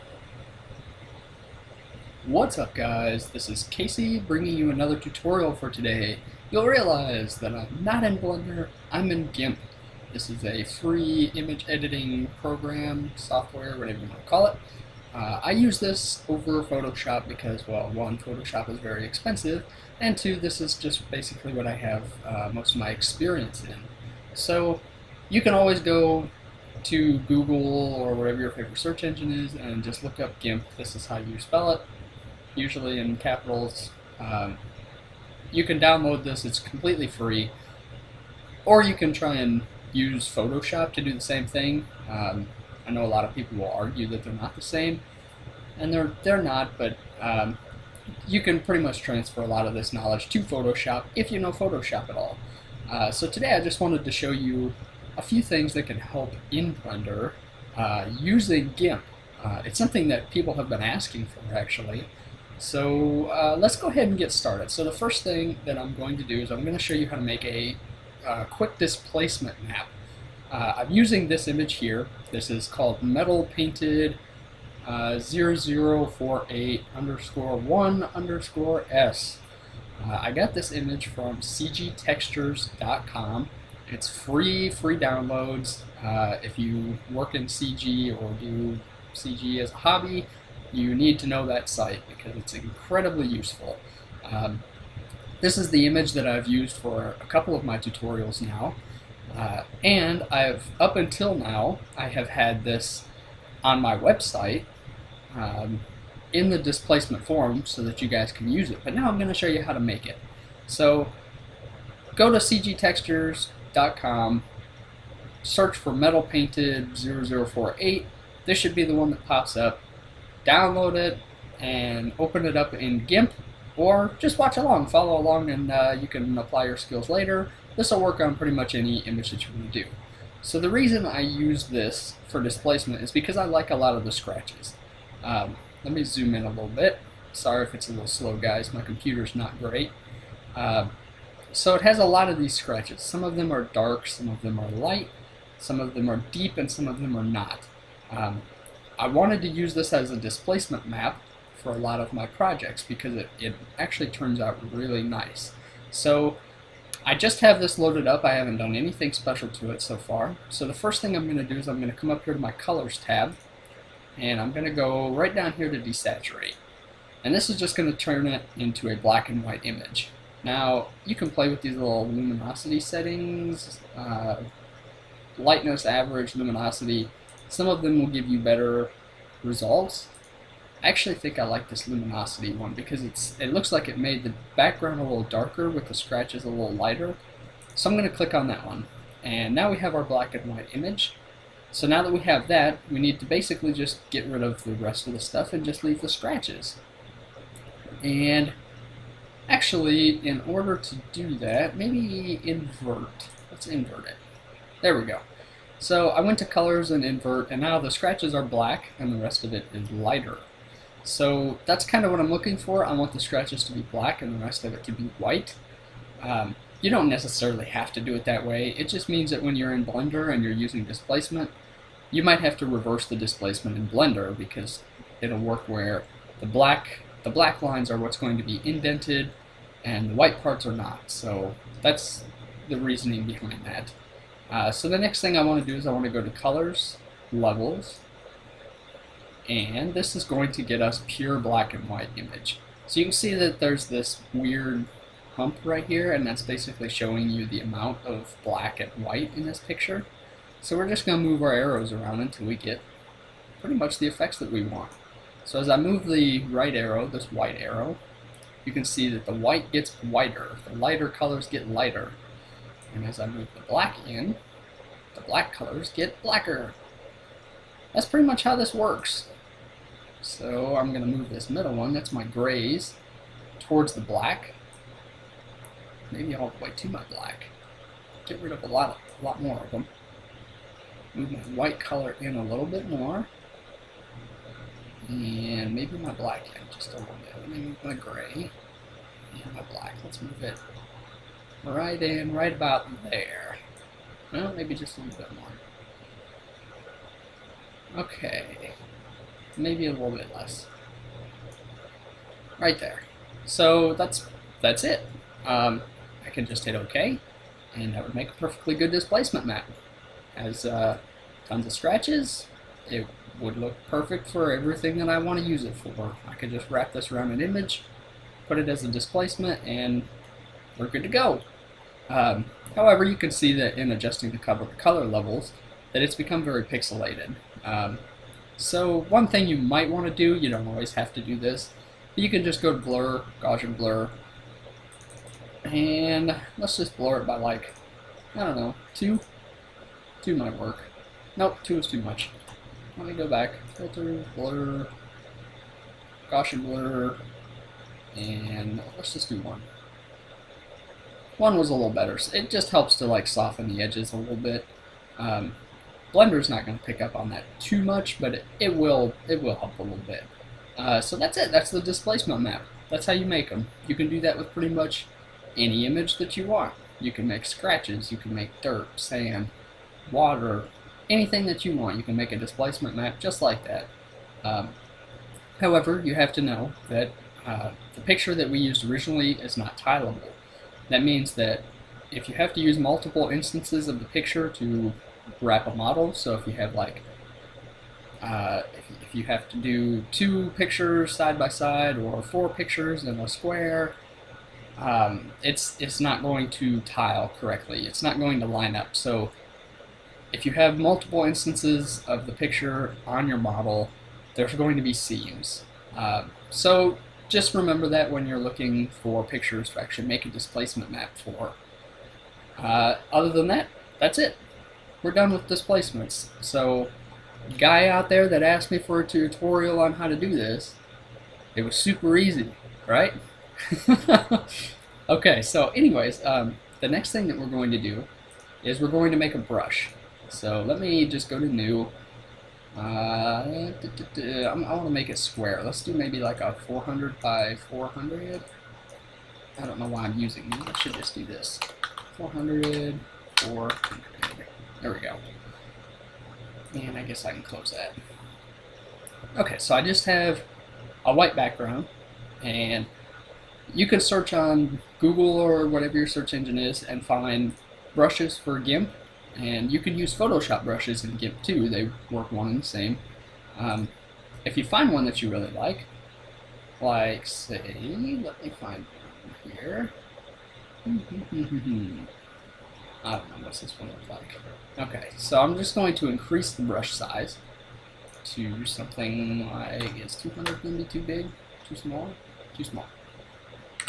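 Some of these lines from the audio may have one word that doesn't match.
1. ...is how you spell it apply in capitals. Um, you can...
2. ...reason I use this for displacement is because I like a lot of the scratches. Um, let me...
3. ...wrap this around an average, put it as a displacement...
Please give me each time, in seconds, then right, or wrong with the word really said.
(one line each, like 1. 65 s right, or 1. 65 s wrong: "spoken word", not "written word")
1. 30 s wrong: "usually", not "apply"
2. 130 s right
3. 316 s wrong: "image", not "average".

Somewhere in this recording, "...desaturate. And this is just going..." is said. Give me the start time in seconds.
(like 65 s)
165 s.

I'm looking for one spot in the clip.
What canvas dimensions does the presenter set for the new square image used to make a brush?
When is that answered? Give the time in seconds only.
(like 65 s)
436 s.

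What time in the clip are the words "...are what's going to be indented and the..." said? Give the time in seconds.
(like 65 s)
227 s.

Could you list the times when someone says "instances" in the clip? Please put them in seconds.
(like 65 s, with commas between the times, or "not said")
383 s, 401 s.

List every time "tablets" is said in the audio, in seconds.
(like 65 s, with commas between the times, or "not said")
not said.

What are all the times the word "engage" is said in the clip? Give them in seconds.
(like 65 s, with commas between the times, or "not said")
not said.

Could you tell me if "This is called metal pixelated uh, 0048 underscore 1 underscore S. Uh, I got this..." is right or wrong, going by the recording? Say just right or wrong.
wrong.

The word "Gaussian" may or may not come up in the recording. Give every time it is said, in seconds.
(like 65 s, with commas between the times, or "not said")
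333 s, 346 s.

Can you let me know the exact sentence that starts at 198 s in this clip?
And actually, in order to do that, maybe invert.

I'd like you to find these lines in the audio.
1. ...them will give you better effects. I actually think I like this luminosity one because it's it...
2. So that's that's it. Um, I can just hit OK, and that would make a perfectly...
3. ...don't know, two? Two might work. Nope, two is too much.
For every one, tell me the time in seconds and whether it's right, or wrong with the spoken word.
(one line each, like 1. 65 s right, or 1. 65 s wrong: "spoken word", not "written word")
1. 177 s wrong: "results", not "effects"
2. 303 s right
3. 338 s right.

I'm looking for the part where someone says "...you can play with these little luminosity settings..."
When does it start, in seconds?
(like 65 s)
171 s.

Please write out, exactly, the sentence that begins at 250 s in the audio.
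So we're just going to move our arrows around until we get pretty much the effects that we want.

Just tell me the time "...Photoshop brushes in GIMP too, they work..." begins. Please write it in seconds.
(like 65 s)
460 s.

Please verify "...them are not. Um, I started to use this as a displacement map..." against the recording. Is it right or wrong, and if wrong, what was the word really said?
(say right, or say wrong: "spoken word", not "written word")
wrong: "wanted", not "started".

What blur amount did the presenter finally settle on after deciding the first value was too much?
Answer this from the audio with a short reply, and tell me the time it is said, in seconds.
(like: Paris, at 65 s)
1, at 348 s.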